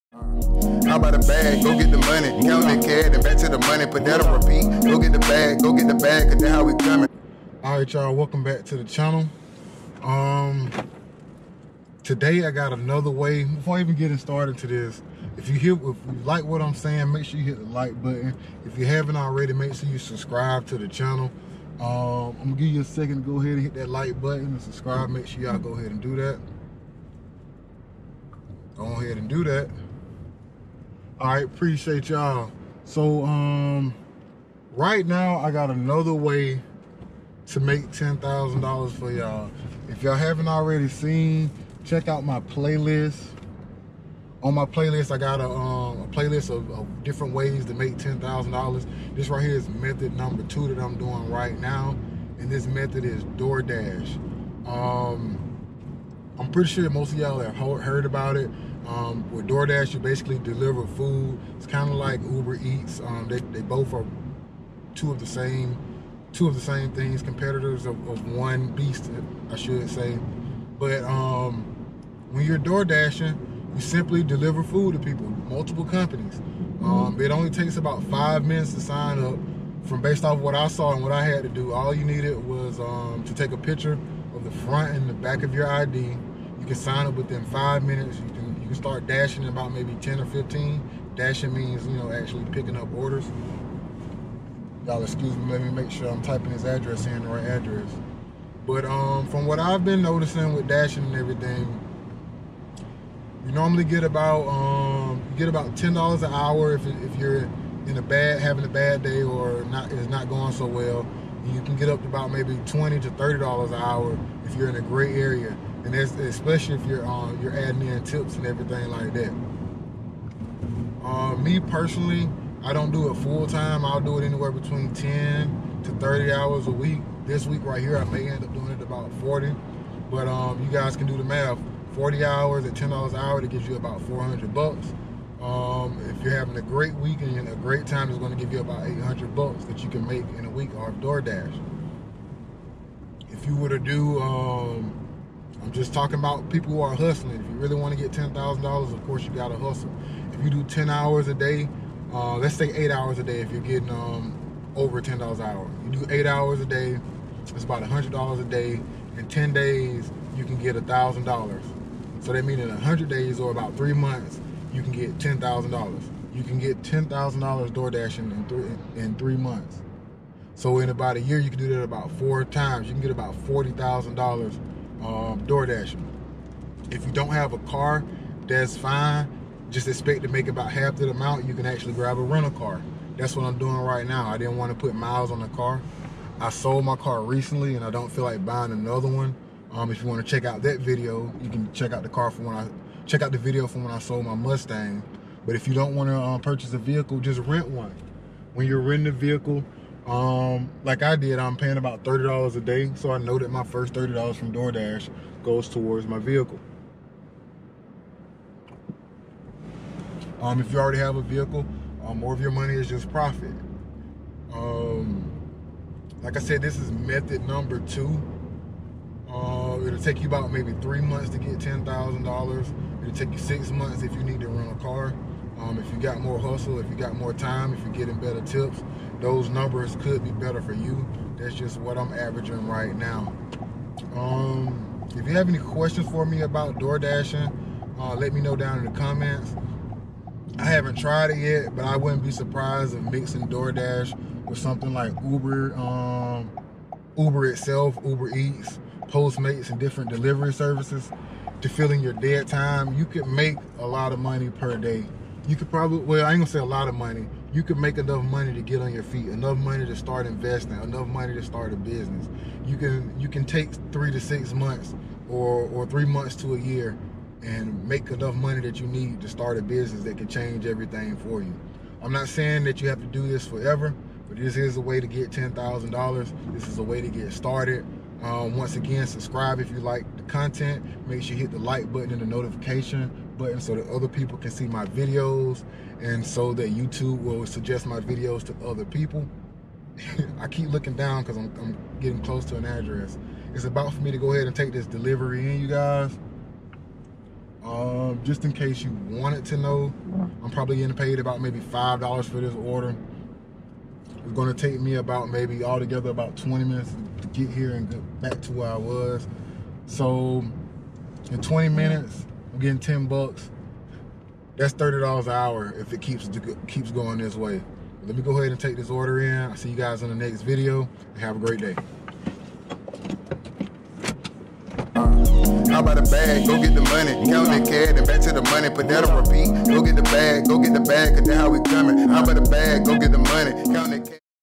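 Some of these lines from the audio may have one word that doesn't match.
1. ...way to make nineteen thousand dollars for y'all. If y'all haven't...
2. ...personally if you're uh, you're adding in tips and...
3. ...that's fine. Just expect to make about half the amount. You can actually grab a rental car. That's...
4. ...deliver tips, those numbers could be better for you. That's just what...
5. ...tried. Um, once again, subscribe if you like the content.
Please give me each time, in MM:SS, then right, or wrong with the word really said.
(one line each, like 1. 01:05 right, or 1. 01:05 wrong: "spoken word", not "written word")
1. 00:36 wrong: "ten", not "nineteen"
2. 01:55 wrong: "especially", not "personally"
3. 02:58 right
4. 03:48 wrong: "better", not "deliver"
5. 04:37 wrong: "started", not "tried".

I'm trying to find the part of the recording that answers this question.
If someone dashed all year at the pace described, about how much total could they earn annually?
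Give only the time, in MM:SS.
02:53.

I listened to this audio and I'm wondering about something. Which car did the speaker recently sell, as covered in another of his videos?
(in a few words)
Mustang.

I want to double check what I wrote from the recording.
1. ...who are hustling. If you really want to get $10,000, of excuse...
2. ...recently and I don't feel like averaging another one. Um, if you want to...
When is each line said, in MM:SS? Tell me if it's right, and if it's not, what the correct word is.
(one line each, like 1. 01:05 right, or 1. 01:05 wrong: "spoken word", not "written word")
1. 02:26 wrong: "course", not "excuse"
2. 03:07 wrong: "buying", not "averaging".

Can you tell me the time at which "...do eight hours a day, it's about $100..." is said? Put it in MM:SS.
02:35.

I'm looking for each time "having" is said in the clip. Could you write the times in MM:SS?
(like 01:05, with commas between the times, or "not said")
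01:48, 02:16.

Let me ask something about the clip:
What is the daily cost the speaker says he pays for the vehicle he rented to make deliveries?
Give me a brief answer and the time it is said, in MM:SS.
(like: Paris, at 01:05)
$30 a day, at 03:22.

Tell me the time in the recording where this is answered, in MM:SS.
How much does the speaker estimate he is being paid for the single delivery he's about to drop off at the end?
05:01.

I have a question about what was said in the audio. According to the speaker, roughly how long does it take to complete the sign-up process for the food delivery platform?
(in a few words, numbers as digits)
5 minutes.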